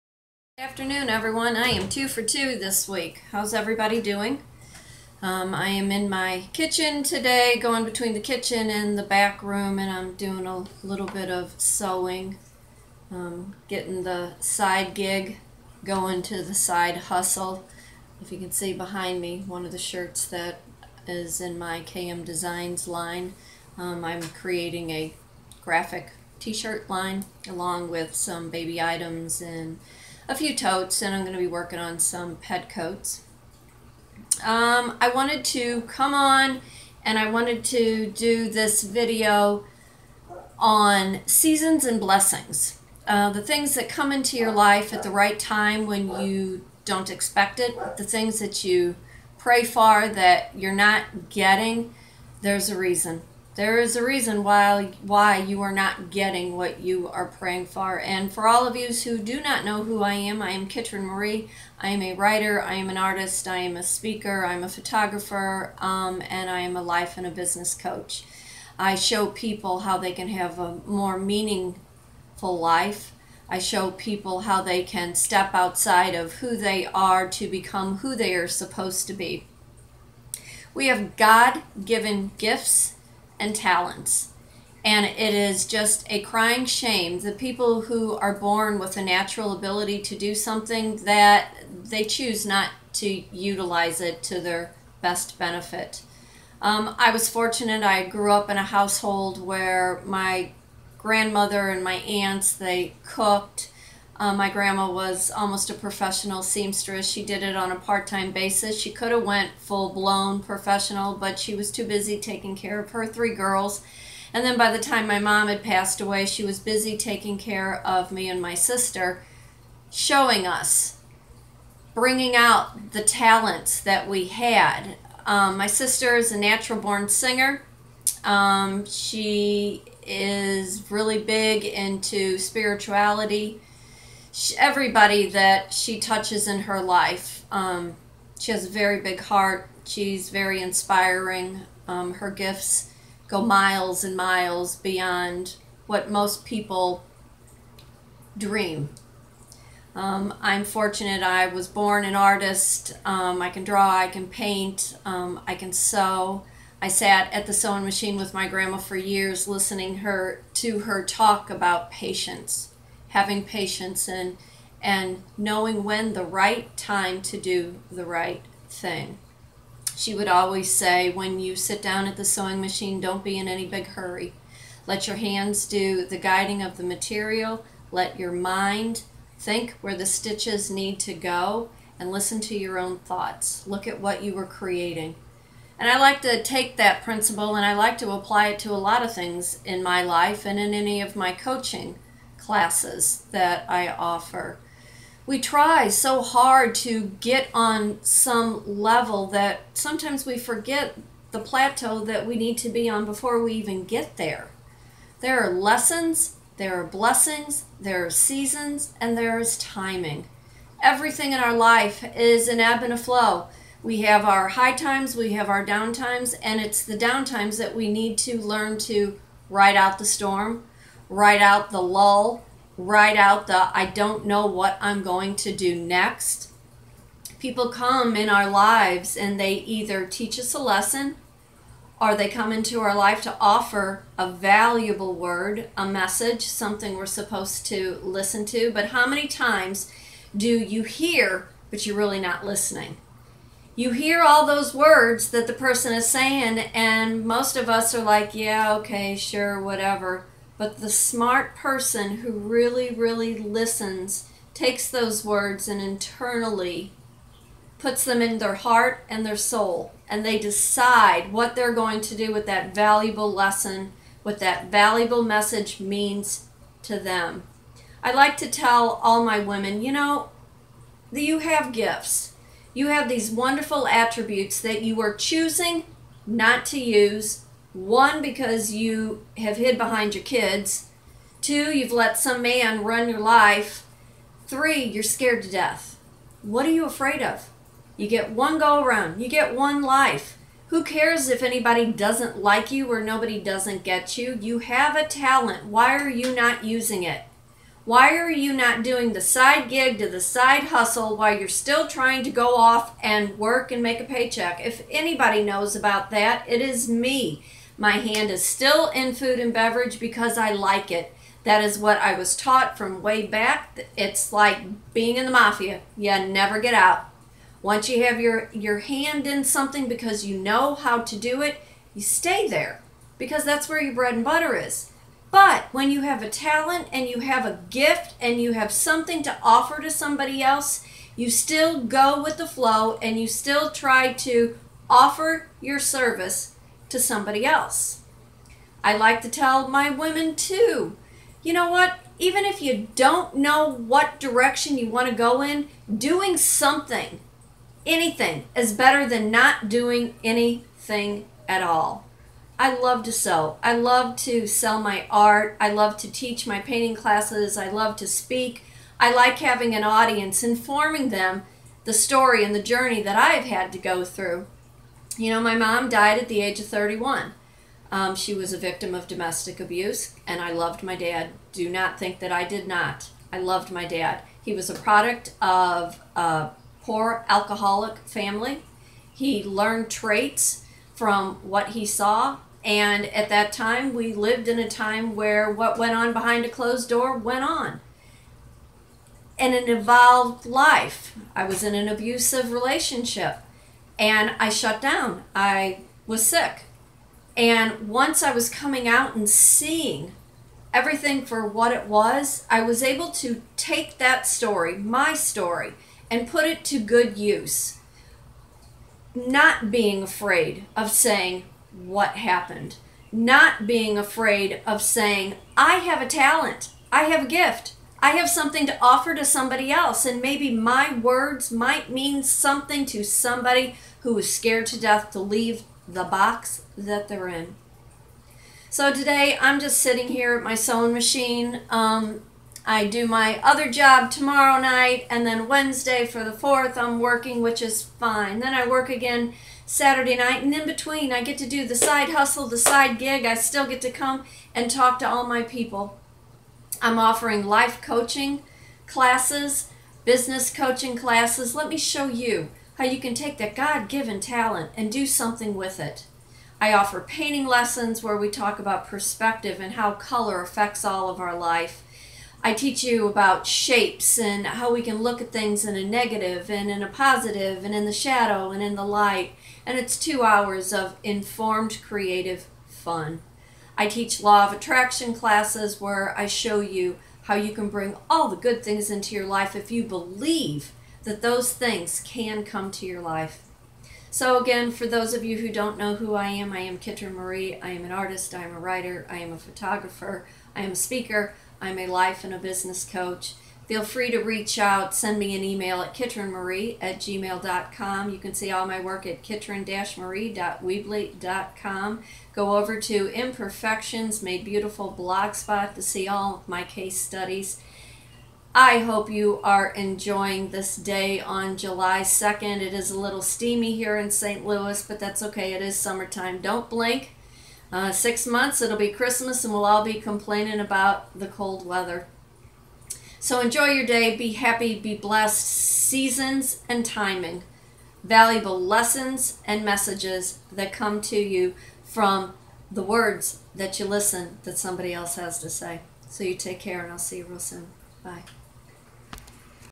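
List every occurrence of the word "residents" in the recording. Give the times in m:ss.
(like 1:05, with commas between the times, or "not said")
not said.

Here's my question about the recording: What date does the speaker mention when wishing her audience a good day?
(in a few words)
July 2.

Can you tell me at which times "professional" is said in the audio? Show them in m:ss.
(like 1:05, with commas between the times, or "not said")
1:45, 1:50.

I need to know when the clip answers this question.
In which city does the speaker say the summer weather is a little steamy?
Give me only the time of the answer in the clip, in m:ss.
8:34.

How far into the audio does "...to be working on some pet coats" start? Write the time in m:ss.
0:31.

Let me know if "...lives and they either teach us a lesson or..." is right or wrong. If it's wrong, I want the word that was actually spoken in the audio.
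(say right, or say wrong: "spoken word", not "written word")
right.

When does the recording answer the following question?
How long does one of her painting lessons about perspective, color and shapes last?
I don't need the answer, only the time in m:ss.
7:49.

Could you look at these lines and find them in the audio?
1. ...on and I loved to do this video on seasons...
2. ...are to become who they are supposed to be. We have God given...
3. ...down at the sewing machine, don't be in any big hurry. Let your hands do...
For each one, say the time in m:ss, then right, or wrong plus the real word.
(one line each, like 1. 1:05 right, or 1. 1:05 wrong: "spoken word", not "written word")
1. 0:36 wrong: "wanted", not "loved"
2. 1:16 right
3. 2:51 right.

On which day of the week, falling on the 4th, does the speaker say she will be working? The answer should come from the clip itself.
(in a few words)
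Wednesday.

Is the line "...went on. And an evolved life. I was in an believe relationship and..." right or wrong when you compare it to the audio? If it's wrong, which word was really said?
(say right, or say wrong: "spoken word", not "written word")
wrong: "abusive", not "believe".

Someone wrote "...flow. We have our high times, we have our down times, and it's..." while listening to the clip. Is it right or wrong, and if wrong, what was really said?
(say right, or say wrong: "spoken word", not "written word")
right.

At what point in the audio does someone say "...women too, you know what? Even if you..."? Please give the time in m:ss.
5:39.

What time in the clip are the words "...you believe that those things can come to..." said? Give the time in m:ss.
7:59.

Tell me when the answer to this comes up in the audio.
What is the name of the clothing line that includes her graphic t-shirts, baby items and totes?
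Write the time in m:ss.
0:21.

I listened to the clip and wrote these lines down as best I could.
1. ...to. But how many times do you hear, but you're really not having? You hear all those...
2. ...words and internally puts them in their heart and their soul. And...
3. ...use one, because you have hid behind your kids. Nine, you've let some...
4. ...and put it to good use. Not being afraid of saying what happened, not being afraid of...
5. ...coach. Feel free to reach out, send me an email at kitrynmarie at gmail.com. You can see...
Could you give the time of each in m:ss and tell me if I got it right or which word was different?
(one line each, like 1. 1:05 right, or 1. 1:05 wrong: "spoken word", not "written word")
1. 3:58 wrong: "listening", not "having"
2. 4:15 right
3. 4:36 wrong: "Two", not "Nine"
4. 6:46 right
5. 8:12 right.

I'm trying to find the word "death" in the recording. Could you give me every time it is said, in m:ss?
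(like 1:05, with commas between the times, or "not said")
4:45, 7:04.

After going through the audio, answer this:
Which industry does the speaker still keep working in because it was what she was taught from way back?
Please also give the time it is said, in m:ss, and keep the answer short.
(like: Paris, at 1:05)
Food and beverage, at 5:09.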